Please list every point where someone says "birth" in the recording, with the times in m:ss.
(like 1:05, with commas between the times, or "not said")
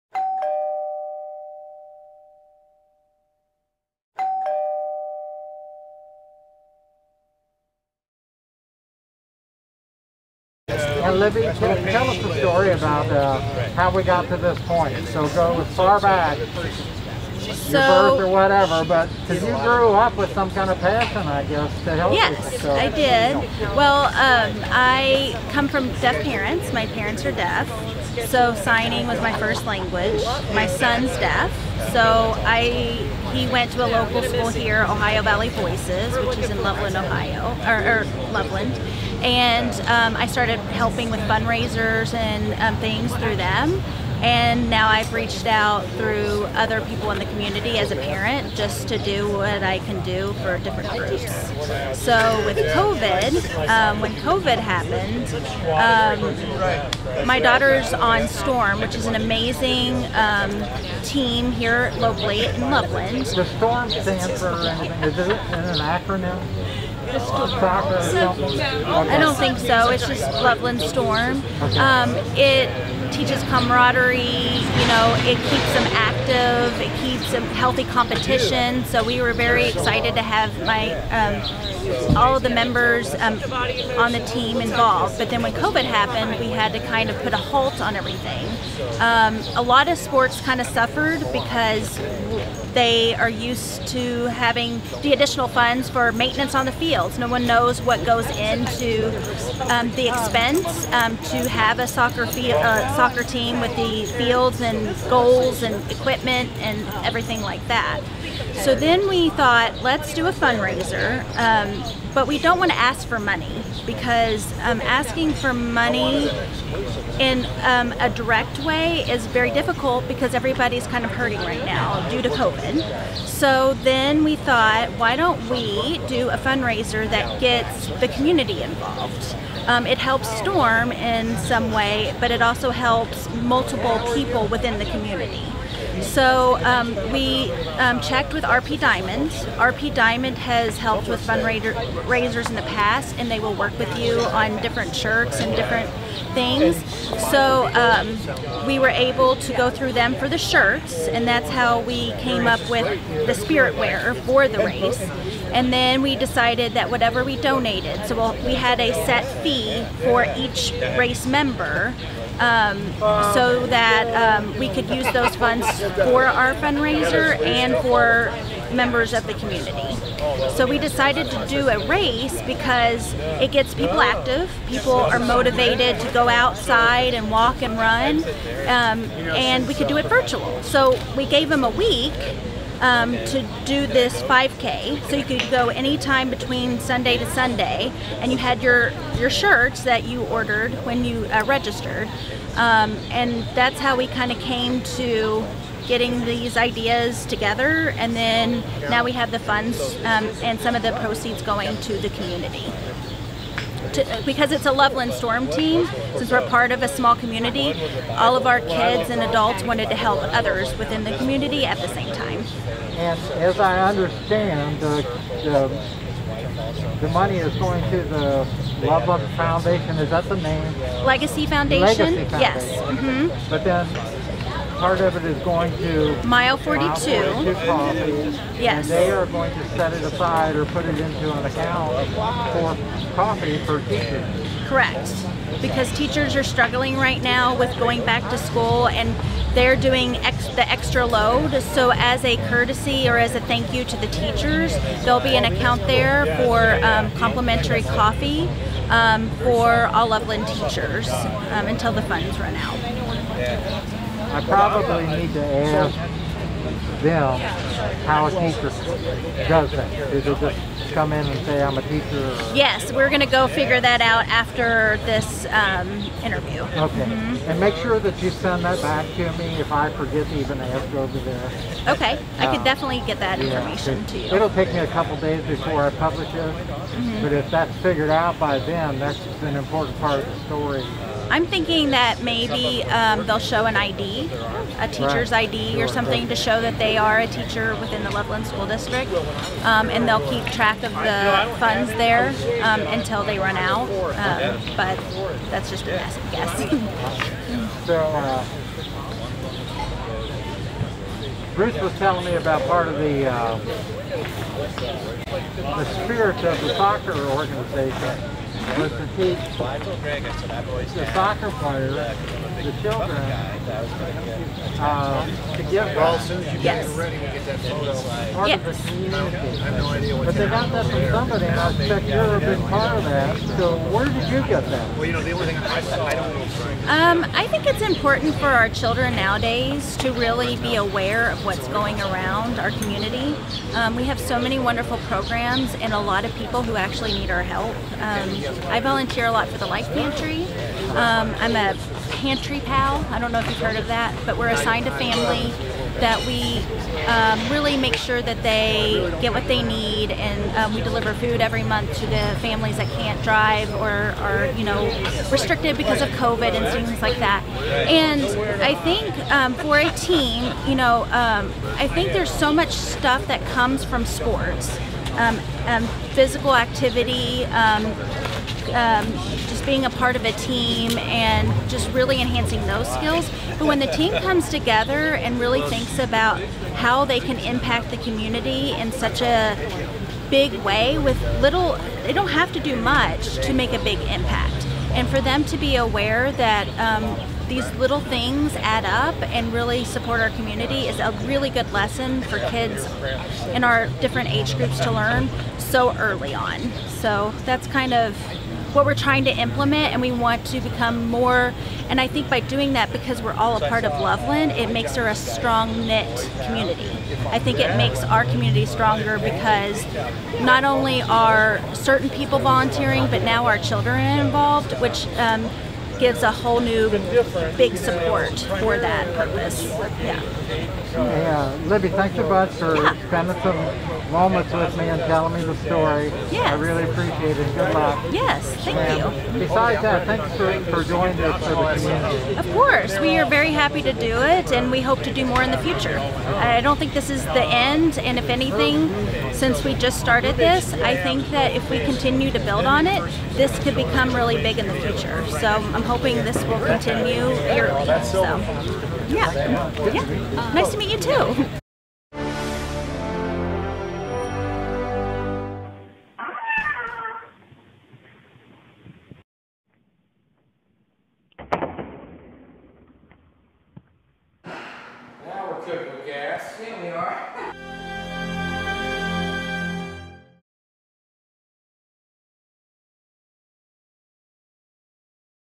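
0:17.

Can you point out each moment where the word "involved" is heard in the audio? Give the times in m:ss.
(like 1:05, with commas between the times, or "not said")
1:24, 2:08, 6:54.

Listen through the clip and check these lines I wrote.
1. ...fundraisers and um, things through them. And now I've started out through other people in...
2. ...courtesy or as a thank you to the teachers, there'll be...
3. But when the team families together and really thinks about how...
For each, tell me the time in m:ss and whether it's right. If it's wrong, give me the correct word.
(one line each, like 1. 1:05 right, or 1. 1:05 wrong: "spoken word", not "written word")
1. 0:41 wrong: "reached", not "started"
2. 4:02 right
3. 6:13 wrong: "comes", not "families".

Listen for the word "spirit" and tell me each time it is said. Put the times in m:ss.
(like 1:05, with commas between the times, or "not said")
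2:33, 5:06.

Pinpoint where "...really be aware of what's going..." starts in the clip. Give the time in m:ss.
5:30.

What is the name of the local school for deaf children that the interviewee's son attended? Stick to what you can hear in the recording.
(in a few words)
Ohio Valley Voices.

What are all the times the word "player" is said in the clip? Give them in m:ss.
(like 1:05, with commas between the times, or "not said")
5:11.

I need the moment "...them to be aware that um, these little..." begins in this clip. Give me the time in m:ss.
6:25.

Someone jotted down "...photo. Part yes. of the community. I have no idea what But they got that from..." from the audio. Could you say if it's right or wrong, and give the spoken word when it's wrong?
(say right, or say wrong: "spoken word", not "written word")
right.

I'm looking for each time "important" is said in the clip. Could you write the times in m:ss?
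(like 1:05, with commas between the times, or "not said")
4:39, 5:27.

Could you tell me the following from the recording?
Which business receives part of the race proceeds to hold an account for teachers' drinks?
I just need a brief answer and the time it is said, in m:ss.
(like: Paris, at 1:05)
Mile 42, at 3:46.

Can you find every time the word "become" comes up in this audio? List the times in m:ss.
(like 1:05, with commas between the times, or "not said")
6:40, 7:23.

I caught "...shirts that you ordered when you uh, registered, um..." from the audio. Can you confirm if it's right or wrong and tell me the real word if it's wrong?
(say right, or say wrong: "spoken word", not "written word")
right.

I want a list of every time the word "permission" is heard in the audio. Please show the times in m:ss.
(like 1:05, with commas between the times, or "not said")
not said.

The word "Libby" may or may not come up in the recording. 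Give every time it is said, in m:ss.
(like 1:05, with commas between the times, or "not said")
0:11, 7:01.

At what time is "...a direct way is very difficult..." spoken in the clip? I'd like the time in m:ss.
1:57.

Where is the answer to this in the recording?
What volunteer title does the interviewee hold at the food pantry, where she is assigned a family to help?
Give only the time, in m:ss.
5:42.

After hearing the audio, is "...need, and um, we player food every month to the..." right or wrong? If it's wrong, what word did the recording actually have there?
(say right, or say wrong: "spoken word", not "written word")
wrong: "deliver", not "player".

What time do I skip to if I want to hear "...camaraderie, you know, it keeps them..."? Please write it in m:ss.
1:13.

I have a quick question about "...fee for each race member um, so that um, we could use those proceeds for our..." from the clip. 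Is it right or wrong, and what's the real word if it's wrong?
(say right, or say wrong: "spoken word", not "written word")
wrong: "funds", not "proceeds".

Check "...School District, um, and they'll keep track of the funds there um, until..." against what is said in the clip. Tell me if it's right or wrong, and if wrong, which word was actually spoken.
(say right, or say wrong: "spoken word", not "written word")
right.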